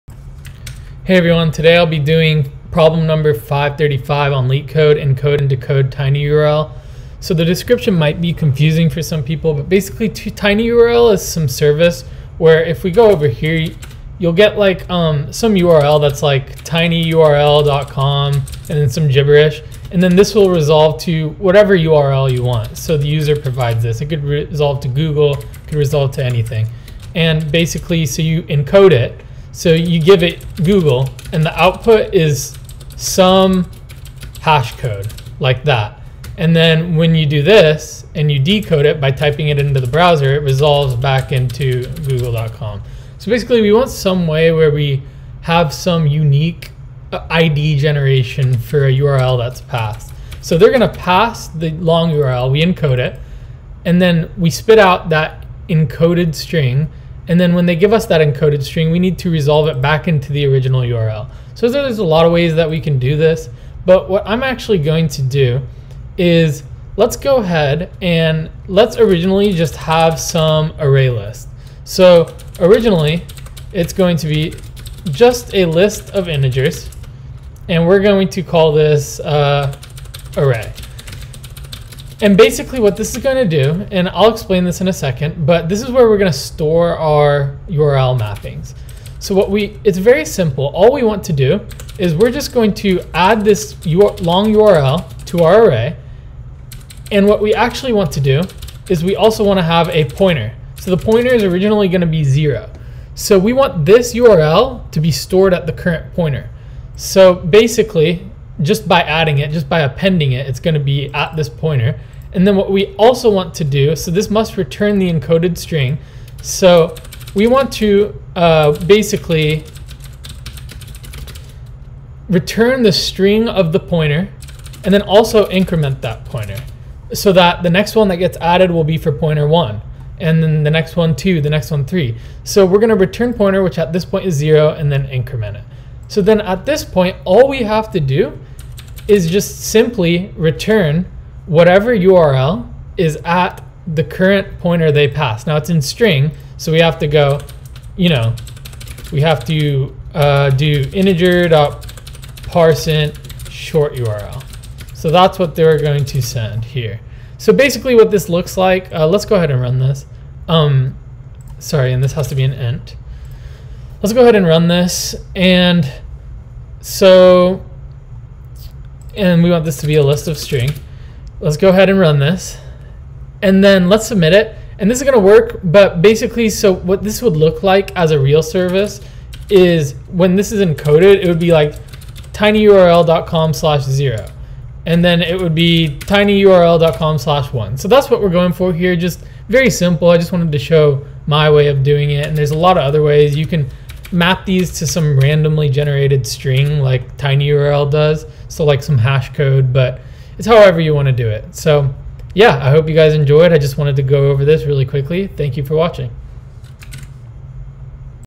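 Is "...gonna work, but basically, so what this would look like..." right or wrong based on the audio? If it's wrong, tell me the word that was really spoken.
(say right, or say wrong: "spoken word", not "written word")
right.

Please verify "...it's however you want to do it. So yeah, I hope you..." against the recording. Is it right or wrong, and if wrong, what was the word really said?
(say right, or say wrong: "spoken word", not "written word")
right.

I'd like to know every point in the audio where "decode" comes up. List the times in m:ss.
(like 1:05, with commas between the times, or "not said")
0:05, 0:38.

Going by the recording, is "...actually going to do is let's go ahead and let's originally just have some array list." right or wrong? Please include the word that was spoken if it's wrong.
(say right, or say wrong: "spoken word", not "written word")
right.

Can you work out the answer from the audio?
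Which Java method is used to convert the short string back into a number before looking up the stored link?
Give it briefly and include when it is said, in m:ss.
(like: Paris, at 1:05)
Integer.parseInt, at 2:30.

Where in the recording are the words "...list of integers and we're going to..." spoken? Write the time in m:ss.
1:15.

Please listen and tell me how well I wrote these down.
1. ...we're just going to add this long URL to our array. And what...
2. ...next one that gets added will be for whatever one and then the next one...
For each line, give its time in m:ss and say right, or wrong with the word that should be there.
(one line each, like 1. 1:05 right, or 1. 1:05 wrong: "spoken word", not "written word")
1. 1:32 right
2. 2:07 wrong: "pointer", not "whatever".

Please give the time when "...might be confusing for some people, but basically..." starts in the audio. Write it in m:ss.
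0:07.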